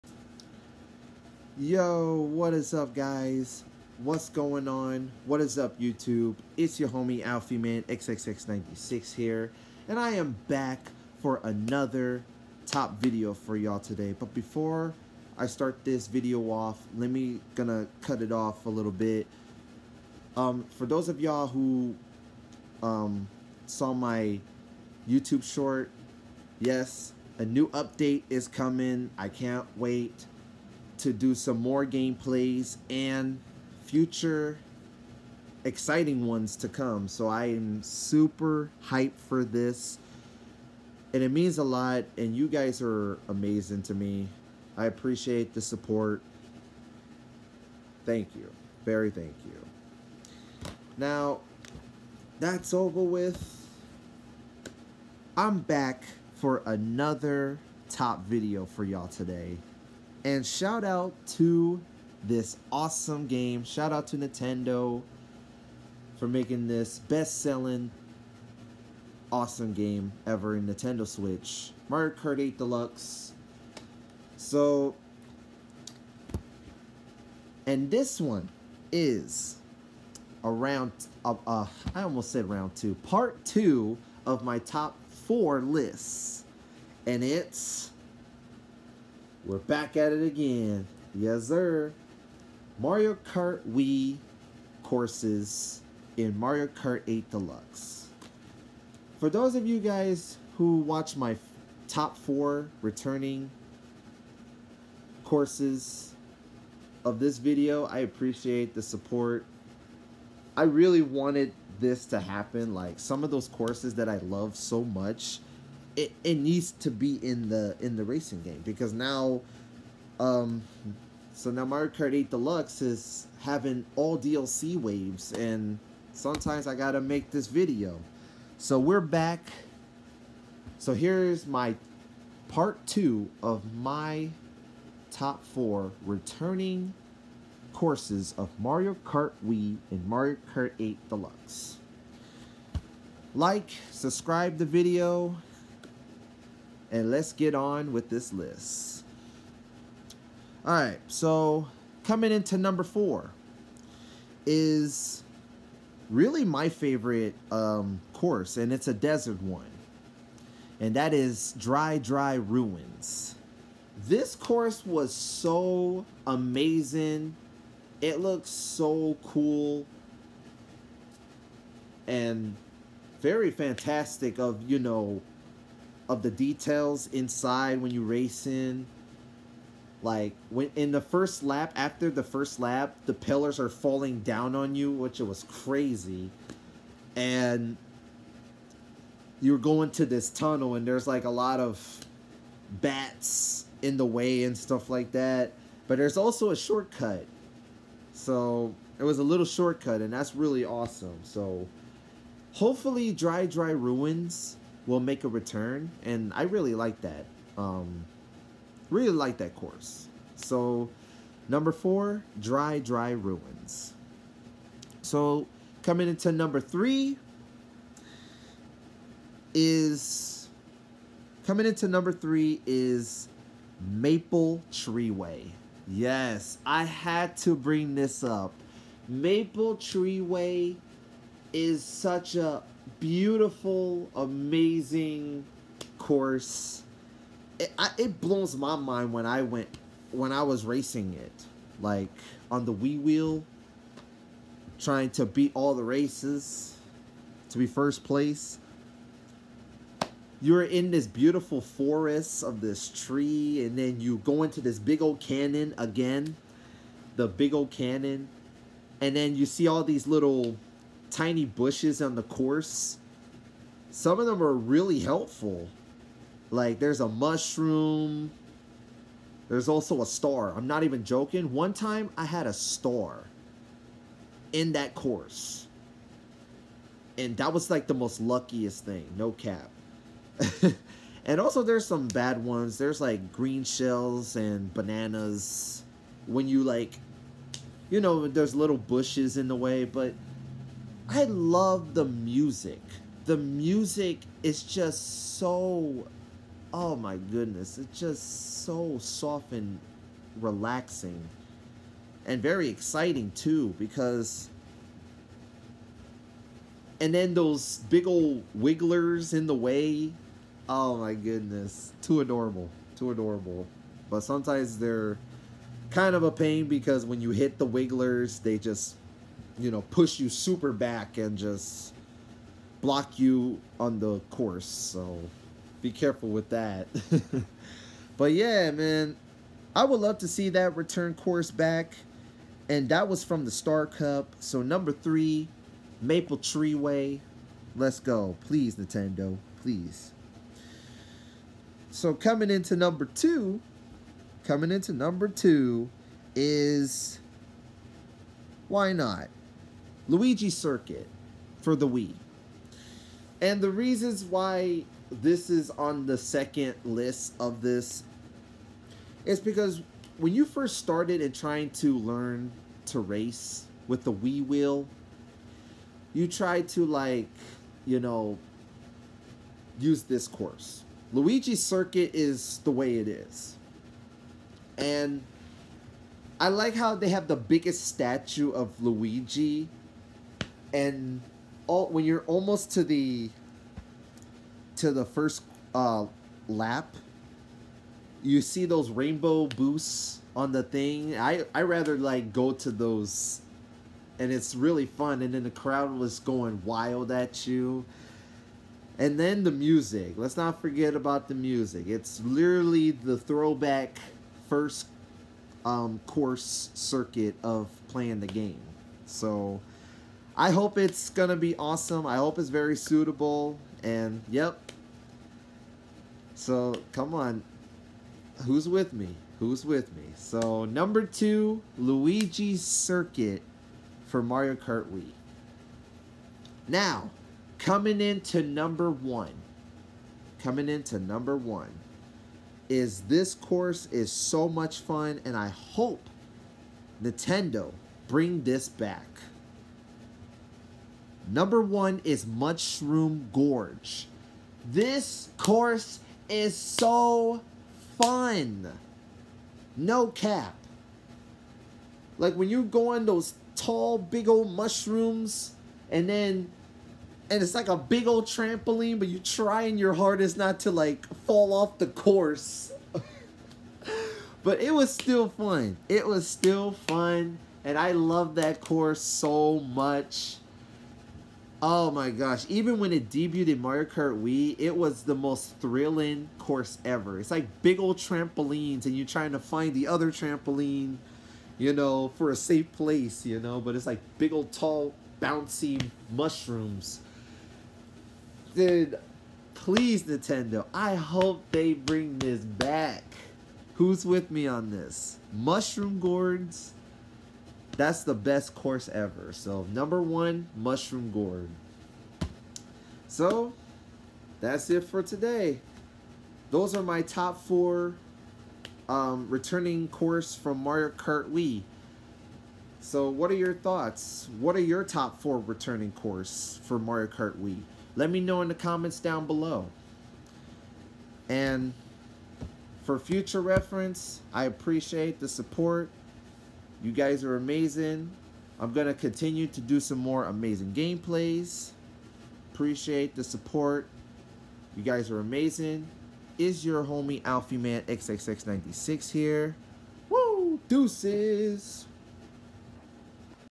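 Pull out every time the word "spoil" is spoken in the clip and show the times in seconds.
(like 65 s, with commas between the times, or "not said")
not said.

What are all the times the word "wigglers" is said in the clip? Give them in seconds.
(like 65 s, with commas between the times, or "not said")
308 s, 317 s.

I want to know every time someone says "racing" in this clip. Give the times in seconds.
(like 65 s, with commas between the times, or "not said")
118 s, 240 s.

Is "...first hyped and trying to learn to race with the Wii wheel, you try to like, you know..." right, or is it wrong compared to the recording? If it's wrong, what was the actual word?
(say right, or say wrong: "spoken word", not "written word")
wrong: "started", not "hyped".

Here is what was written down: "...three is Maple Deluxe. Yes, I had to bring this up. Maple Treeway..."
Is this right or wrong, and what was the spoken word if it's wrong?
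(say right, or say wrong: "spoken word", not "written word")
wrong: "Treeway", not "Deluxe".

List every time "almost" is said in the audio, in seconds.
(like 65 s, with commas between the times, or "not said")
82 s, 382 s.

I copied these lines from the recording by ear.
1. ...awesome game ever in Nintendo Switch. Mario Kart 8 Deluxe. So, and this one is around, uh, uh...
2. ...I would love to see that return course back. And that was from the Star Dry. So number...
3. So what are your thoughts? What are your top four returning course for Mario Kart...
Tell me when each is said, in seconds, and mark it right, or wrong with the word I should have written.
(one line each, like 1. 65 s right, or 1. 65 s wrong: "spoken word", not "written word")
1. 69 s right
2. 329 s wrong: "Cup", not "Dry"
3. 512 s right.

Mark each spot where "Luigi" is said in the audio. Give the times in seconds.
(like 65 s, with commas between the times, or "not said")
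350 s, 371 s, 378 s, 421 s.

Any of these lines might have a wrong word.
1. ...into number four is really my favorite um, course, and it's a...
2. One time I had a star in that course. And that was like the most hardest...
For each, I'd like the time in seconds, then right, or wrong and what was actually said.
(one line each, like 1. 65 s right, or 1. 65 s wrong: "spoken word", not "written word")
1. 152 s right
2. 271 s wrong: "luckiest", not "hardest".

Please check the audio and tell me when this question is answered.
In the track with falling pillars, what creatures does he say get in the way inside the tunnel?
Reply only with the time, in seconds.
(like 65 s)
192 s.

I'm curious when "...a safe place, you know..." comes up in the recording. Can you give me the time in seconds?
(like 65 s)
482 s.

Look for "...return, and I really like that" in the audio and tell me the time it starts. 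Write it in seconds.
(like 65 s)
205 s.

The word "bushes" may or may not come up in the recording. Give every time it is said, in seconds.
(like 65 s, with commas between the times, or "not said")
261 s, 288 s.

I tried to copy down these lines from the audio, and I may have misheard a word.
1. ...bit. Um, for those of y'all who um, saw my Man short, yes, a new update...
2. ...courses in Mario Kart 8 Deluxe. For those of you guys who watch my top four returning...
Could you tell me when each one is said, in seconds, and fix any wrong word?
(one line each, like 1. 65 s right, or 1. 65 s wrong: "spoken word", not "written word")
1. 18 s wrong: "YouTube", not "Man"
2. 94 s right.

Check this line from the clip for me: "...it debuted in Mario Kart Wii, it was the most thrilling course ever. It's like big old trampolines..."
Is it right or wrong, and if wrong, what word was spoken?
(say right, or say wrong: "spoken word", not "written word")
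right.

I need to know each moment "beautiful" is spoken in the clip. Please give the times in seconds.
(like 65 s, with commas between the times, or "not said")
233 s, 251 s.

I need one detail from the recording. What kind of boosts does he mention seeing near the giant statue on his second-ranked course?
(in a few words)
Rainbow boosts.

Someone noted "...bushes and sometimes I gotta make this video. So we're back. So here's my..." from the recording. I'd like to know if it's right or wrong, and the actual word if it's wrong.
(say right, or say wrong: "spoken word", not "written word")
wrong: "waves", not "bushes".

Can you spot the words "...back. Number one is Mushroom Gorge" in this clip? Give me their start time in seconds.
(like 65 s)
438 s.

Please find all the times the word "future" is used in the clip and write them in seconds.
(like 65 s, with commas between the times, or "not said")
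33 s, 522 s.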